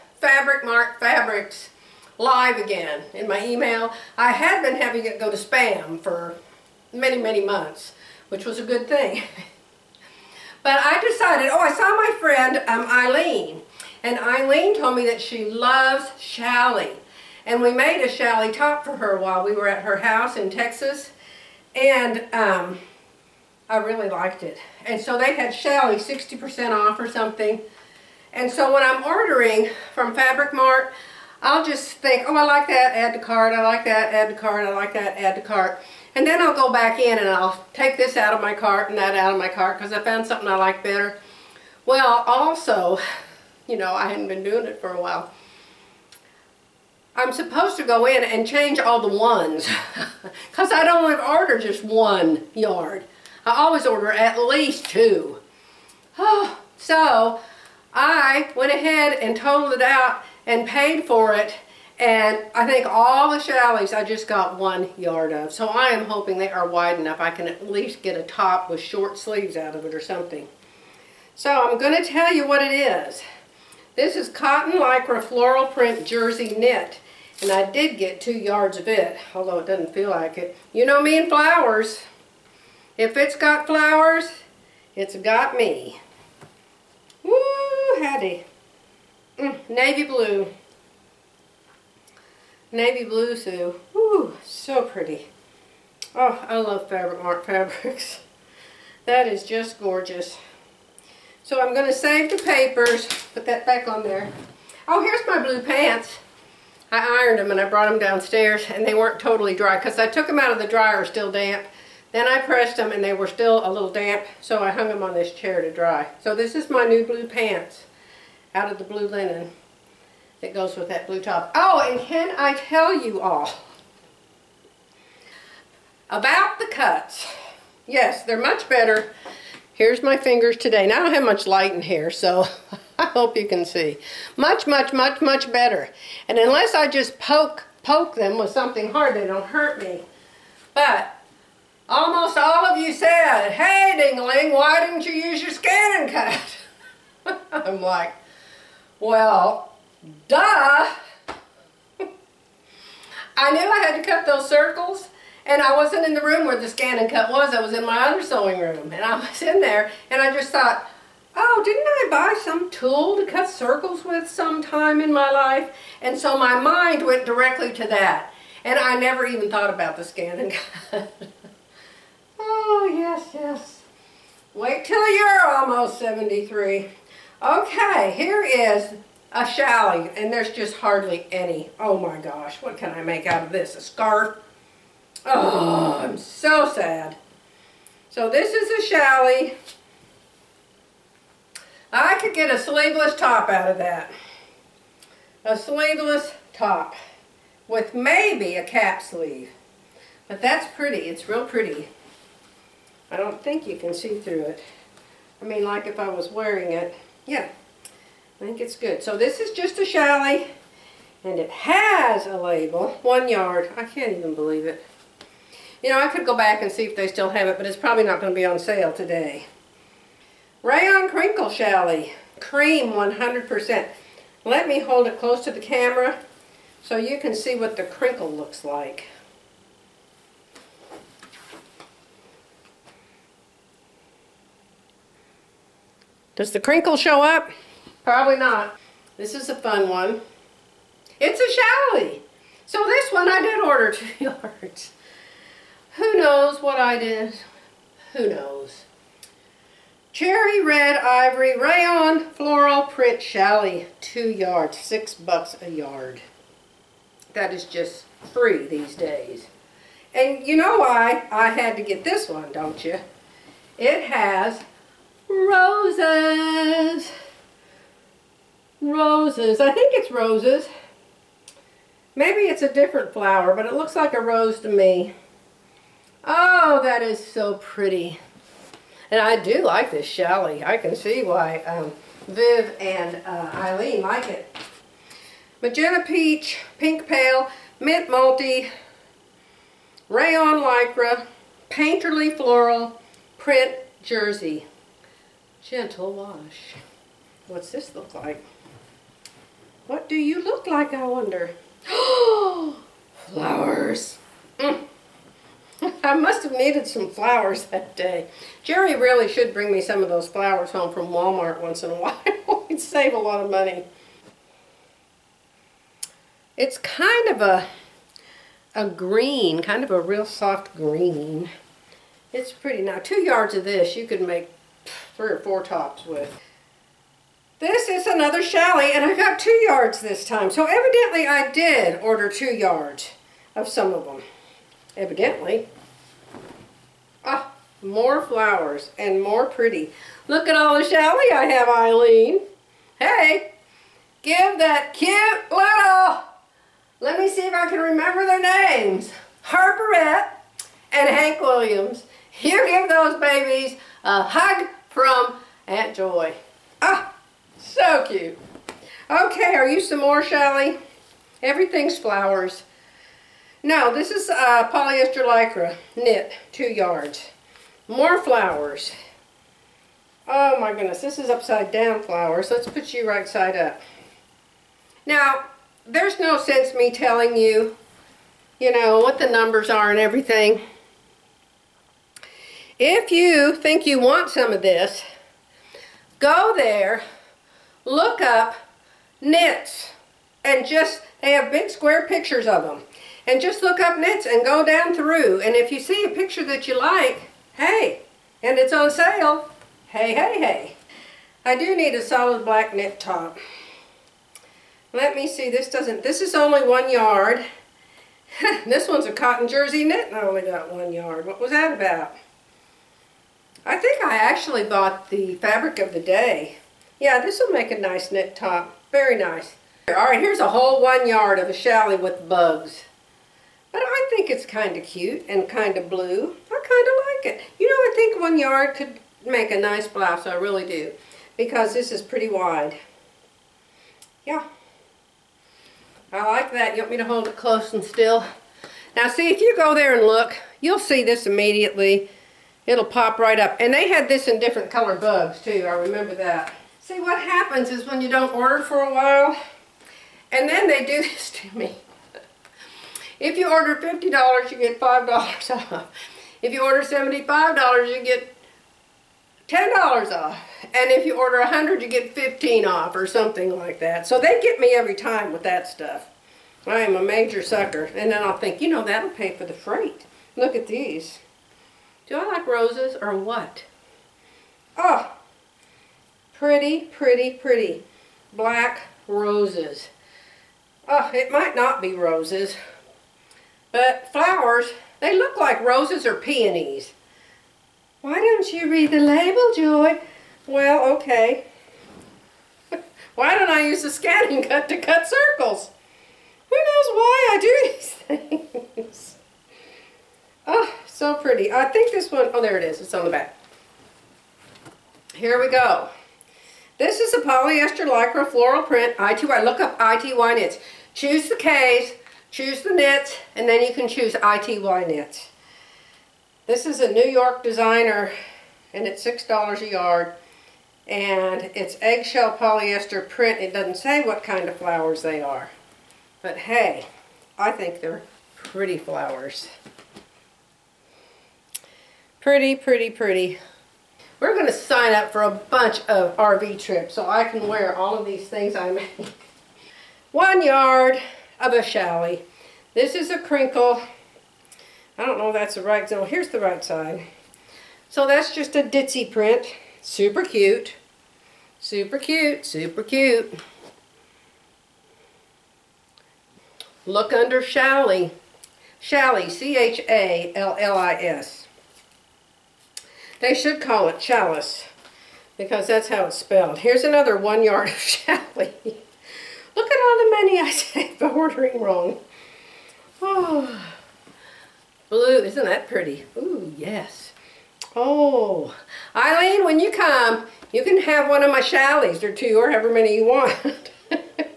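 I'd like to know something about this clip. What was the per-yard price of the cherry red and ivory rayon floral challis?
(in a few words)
$6.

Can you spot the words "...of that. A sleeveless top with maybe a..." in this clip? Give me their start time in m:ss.
3:13.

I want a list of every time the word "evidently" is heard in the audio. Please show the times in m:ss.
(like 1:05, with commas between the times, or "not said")
5:30, 5:34.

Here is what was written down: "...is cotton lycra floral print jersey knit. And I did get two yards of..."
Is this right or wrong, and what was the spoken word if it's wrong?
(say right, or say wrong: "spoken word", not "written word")
right.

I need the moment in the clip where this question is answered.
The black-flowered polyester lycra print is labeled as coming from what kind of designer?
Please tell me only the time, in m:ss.
8:36.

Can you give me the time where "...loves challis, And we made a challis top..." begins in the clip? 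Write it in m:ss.
0:15.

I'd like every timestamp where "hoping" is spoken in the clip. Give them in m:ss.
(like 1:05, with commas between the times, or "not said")
1:06.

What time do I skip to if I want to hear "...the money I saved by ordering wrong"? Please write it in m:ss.
9:29.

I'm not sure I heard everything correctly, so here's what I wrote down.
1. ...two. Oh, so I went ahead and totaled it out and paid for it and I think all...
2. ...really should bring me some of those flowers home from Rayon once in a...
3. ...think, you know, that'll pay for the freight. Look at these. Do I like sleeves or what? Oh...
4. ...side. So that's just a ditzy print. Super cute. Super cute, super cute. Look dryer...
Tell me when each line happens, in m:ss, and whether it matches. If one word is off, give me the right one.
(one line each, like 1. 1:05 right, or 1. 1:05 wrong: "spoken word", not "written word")
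1. 0:54 right
2. 5:08 wrong: "Walmart", not "Rayon"
3. 7:48 wrong: "roses", not "sleeves"
4. 9:06 wrong: "under", not "dryer".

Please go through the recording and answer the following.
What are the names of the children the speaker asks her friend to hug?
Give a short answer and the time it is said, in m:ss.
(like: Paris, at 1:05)
Harperette and Hank Williams, at 5:49.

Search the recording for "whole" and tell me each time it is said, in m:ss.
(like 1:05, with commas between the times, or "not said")
7:00.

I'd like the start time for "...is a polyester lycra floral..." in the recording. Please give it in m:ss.
8:26.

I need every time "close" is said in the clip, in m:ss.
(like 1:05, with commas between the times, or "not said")
3:45, 7:17.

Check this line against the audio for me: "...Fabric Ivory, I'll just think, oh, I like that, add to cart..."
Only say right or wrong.
wrong.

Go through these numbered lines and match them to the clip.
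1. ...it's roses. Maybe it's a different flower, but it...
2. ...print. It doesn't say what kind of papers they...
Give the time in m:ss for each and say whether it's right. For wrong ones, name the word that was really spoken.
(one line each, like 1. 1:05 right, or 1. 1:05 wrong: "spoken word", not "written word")
1. 4:29 right
2. 8:43 wrong: "flowers", not "papers".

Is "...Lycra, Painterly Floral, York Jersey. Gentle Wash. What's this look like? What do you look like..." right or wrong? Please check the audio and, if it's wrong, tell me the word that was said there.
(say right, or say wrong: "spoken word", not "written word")
wrong: "Print", not "York".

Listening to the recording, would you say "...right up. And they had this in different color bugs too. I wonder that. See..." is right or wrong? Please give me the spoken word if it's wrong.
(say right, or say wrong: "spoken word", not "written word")
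wrong: "remember", not "wonder".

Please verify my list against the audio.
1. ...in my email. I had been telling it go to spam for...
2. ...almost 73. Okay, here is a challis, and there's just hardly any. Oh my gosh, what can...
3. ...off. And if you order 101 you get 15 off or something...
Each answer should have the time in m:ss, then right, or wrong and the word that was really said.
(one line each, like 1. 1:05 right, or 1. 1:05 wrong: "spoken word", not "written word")
1. 0:03 wrong: "having", not "telling"
2. 2:55 right
3. 7:40 wrong: "100", not "101".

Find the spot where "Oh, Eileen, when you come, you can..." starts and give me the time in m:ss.
9:37.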